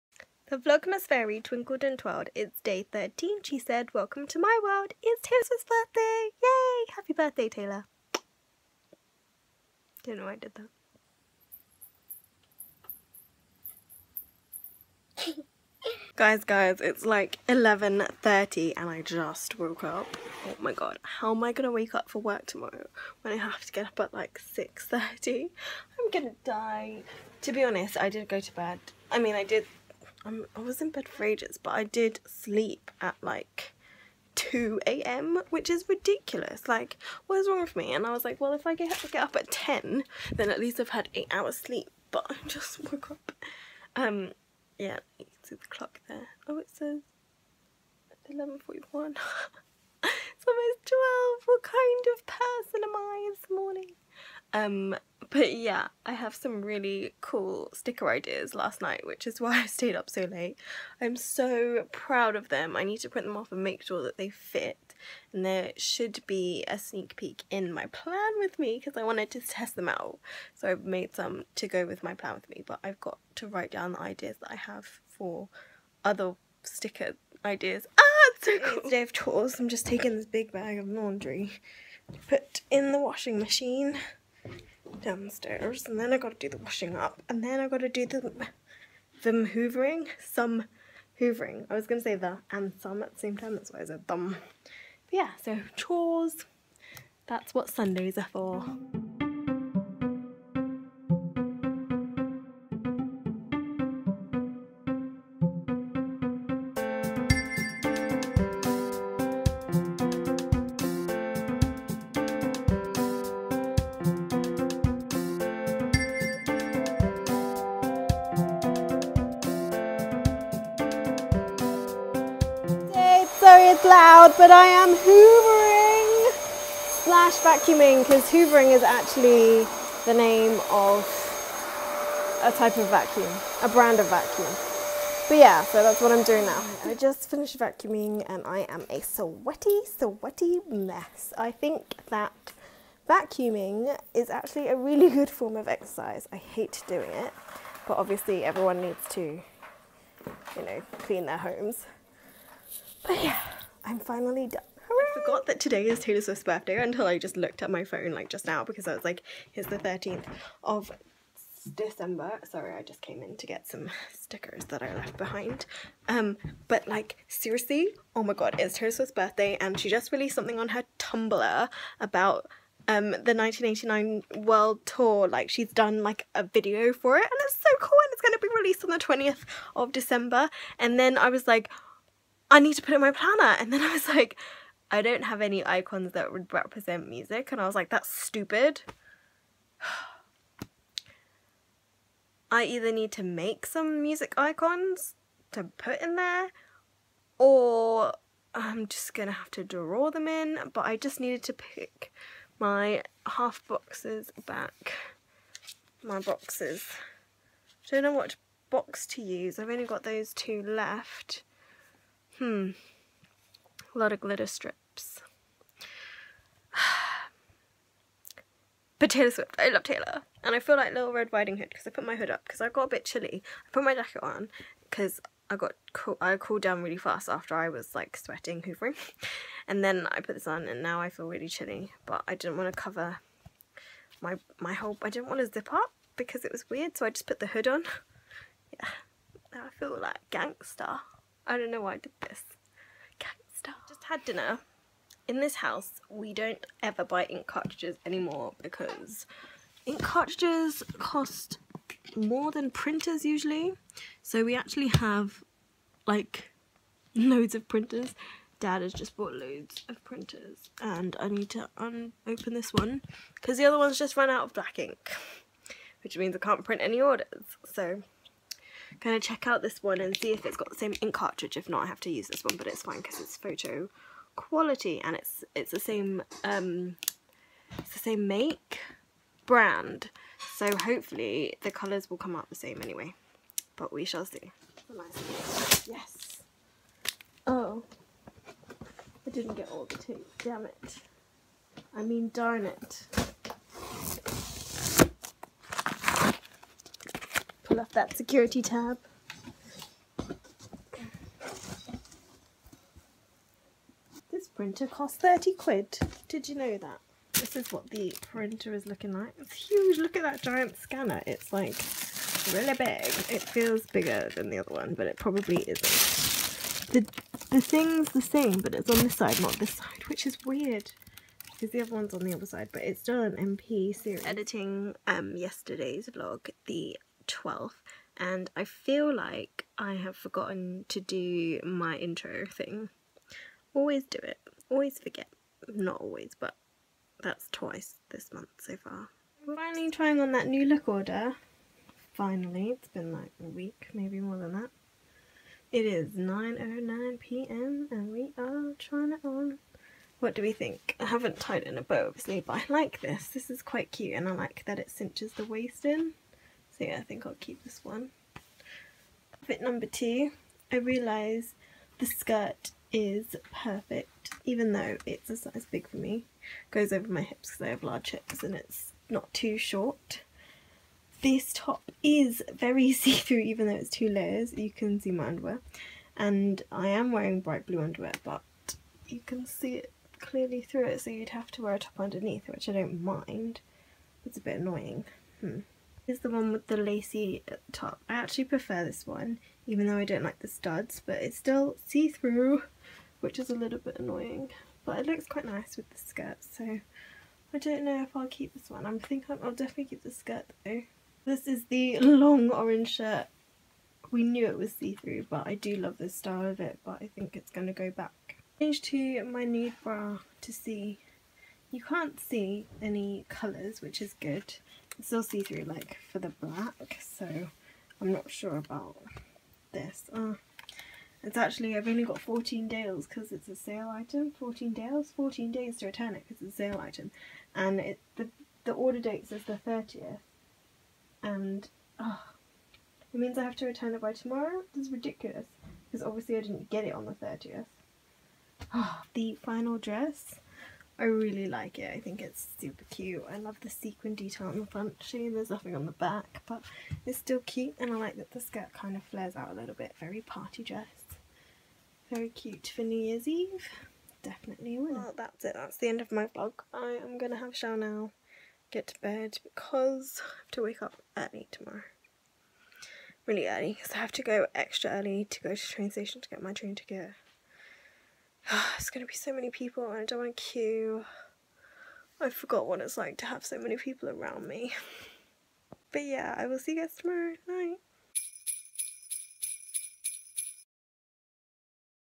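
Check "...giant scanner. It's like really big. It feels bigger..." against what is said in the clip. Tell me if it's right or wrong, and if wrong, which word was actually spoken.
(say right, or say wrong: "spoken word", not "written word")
right.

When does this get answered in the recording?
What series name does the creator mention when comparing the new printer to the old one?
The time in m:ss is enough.
5:23.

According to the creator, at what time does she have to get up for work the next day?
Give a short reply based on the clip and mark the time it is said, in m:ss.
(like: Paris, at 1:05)
6:30, at 0:24.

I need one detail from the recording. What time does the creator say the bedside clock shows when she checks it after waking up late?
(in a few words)
11:41.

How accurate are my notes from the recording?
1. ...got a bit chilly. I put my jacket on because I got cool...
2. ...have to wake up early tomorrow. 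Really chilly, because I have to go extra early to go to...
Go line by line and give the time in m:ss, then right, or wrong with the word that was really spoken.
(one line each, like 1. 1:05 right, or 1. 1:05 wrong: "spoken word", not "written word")
1. 3:42 right
2. 7:40 wrong: "early", not "chilly".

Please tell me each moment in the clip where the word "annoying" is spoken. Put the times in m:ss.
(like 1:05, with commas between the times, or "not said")
6:24, 6:33.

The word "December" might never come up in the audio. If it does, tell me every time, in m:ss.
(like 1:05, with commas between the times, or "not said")
2:41, 2:59.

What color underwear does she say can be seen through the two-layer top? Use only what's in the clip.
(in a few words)
Bright blue.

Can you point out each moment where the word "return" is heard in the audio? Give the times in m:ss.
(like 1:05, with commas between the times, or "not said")
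7:05, 7:13.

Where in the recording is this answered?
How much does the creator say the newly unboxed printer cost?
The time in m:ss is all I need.
5:05.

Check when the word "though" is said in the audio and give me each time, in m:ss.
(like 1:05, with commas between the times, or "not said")
6:04, 6:13, 6:29, 6:40.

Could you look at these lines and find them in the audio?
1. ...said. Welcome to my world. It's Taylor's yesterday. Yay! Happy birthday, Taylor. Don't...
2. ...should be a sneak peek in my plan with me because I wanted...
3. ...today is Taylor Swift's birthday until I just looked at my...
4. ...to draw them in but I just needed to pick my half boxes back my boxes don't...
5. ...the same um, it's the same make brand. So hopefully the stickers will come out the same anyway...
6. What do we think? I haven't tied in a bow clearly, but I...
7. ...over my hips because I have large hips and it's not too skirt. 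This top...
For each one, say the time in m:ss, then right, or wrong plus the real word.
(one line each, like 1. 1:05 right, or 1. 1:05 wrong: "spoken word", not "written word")
1. 0:03 wrong: "birthday", not "yesterday"
2. 1:05 right
3. 2:35 right
4. 3:19 right
5. 4:35 wrong: "colours", not "stickers"
6. 5:50 wrong: "obviously", not "clearly"
7. 6:06 wrong: "short", not "skirt".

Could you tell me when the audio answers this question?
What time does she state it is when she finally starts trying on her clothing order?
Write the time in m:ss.
5:46.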